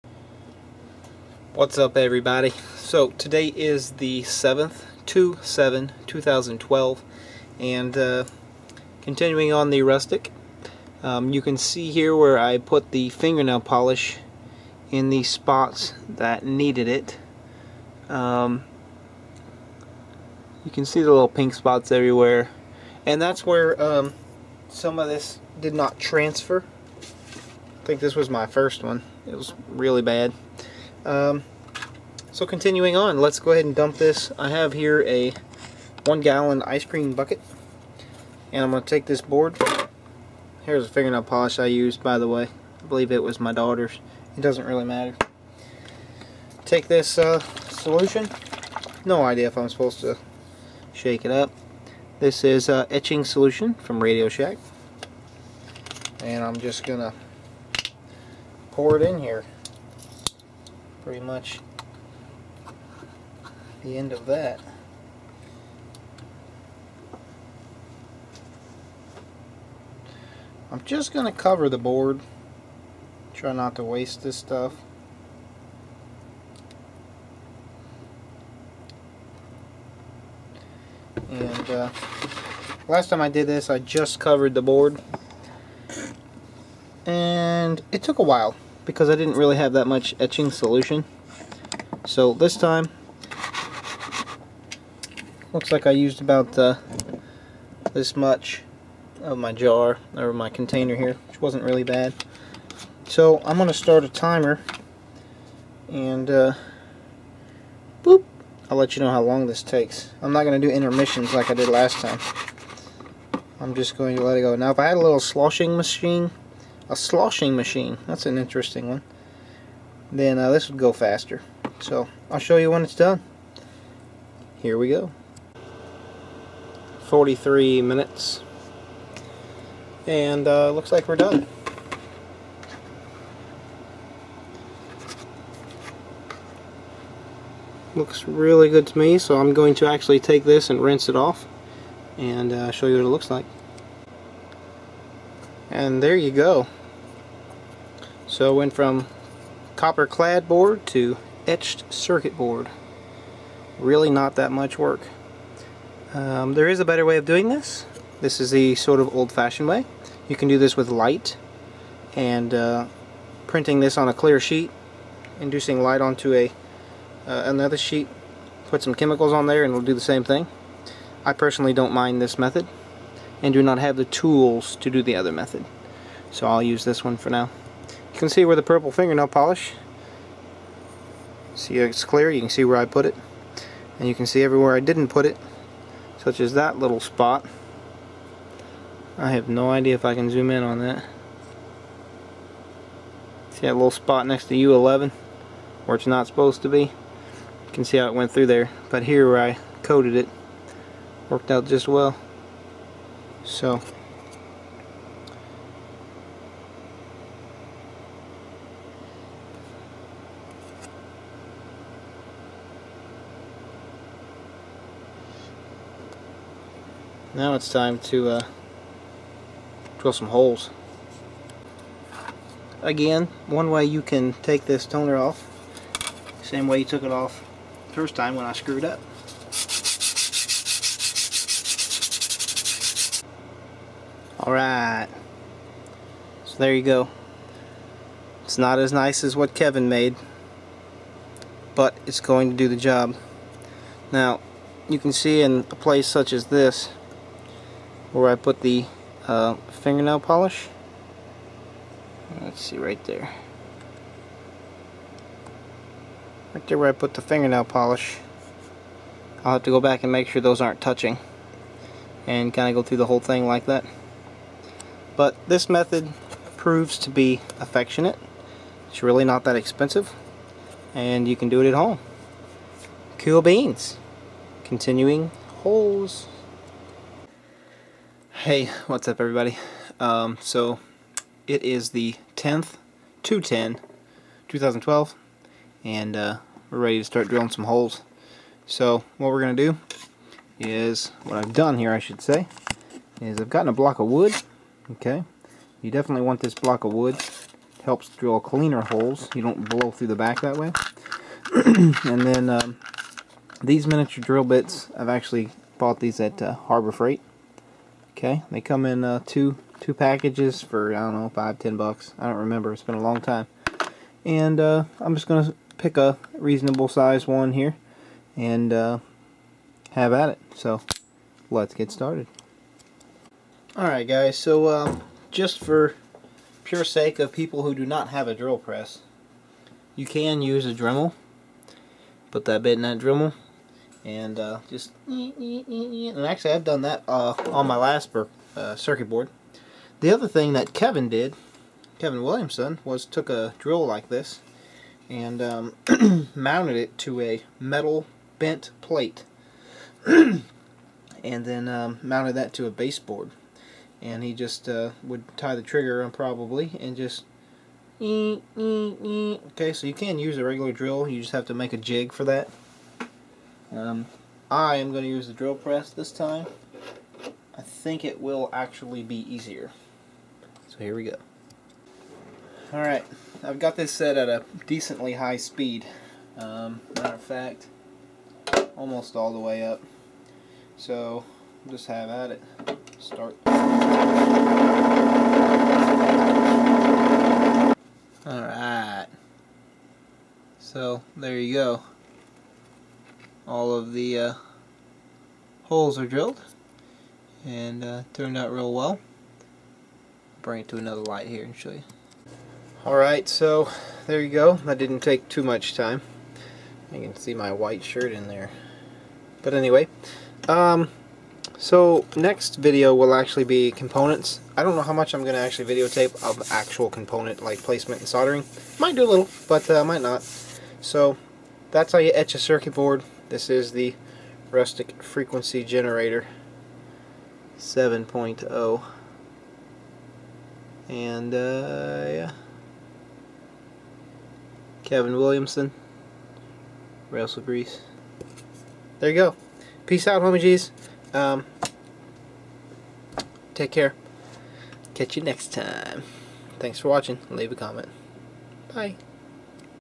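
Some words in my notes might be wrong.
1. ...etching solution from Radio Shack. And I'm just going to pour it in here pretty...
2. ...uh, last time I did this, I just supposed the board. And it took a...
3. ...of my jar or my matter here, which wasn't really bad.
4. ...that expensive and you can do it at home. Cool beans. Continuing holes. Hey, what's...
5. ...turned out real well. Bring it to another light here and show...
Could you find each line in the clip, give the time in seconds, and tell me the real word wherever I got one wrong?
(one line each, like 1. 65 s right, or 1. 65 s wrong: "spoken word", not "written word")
1. 52 s right
2. 81 s wrong: "covered", not "supposed"
3. 99 s wrong: "container", not "matter"
4. 269 s right
5. 398 s right.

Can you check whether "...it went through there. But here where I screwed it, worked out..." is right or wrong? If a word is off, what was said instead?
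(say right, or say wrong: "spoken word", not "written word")
wrong: "coated", not "screwed".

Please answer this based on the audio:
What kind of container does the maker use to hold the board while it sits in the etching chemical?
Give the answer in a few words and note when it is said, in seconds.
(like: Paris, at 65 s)
one gallon ice cream bucket, at 36 s.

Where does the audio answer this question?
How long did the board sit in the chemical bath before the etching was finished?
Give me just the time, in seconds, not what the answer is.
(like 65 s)
127 s.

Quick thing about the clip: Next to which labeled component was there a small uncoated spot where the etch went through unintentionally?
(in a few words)
U11.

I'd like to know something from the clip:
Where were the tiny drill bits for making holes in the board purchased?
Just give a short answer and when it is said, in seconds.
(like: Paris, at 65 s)
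Harbor Freight, at 306 s.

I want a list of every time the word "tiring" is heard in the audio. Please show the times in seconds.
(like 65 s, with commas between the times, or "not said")
not said.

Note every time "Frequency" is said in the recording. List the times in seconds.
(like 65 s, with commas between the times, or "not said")
425 s.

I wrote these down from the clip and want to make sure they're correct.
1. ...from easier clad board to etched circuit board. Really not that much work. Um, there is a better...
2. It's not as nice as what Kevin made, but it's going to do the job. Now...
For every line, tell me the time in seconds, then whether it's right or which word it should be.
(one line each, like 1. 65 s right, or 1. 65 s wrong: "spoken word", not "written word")
1. 148 s wrong: "copper", not "easier"
2. 238 s right.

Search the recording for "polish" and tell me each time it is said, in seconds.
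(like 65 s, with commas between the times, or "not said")
13 s, 41 s, 179 s, 250 s, 257 s.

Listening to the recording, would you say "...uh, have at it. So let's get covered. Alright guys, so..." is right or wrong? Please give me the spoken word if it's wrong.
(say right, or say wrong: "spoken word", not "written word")
wrong: "started", not "covered".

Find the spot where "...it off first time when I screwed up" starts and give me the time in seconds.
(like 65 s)
227 s.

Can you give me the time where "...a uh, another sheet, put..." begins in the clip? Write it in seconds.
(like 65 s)
166 s.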